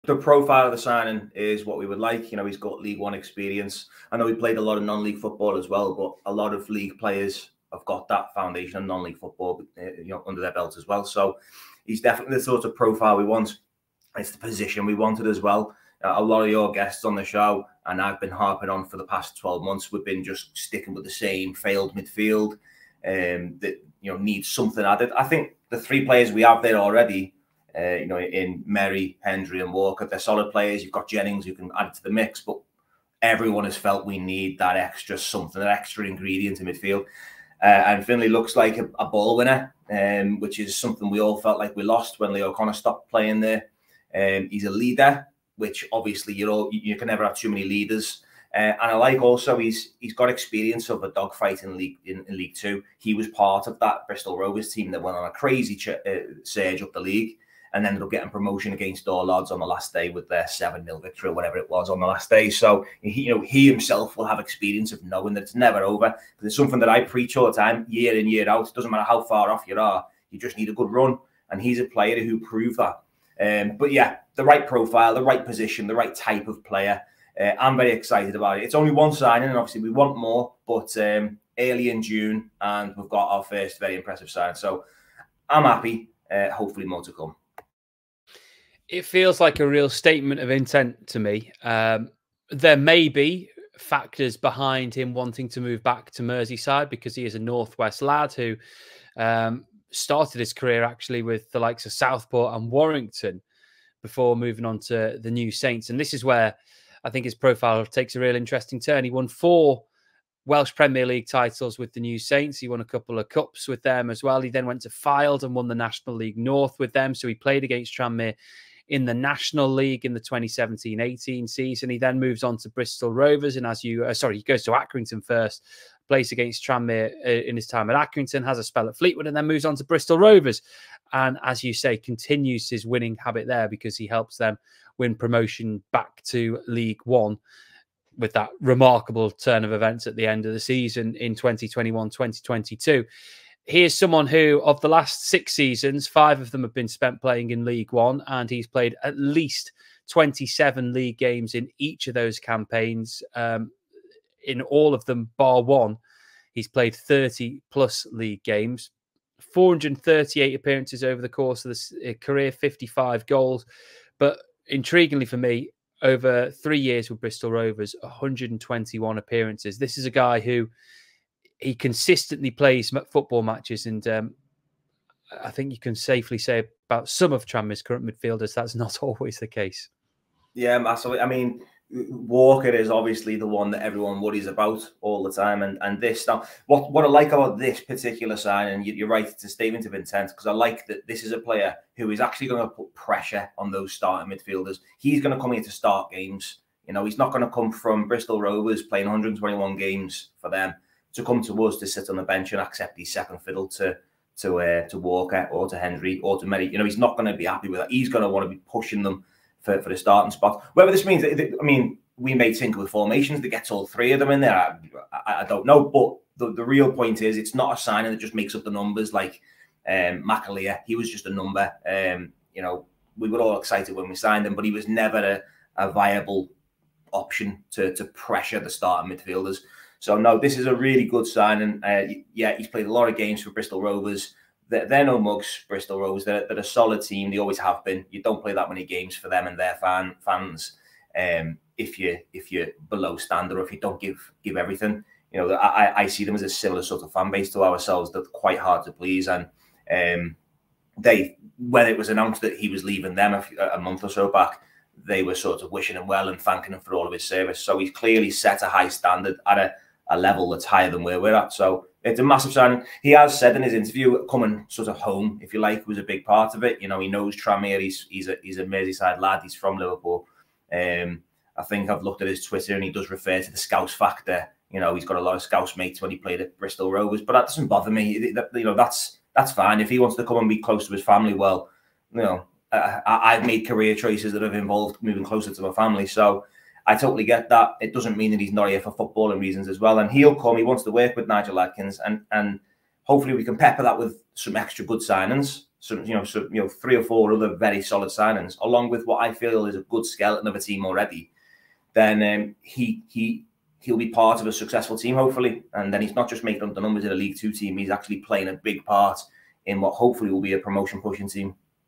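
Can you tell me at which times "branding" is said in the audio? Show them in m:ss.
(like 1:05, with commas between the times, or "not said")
not said.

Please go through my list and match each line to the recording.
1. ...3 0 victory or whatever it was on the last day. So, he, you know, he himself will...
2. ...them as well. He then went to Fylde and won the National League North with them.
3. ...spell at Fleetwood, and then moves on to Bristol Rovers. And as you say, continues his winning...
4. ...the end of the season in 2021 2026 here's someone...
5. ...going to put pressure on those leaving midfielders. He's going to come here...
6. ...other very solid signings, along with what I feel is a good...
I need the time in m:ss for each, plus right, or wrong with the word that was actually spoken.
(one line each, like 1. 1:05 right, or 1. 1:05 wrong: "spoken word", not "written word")
1. 1:00 wrong: "7", not "3"
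2. 1:53 right
3. 2:08 right
4. 2:20 wrong: "2022", not "2026"
5. 3:12 wrong: "starting", not "leaving"
6. 4:57 right.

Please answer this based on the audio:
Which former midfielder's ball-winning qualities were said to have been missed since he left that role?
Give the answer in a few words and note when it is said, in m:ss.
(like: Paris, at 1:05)
Lee O'Connor, at 0:42.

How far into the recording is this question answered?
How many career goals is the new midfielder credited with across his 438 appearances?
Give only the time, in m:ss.
2:42.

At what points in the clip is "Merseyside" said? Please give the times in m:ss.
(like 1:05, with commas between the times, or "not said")
1:36, 4:28.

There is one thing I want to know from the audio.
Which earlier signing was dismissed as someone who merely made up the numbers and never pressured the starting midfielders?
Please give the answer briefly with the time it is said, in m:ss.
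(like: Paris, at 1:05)
McAlear, at 3:40.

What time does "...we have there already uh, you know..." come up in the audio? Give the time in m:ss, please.
0:26.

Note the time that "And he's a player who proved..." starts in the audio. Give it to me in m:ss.
1:11.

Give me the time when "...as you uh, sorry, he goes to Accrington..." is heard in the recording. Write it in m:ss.
2:03.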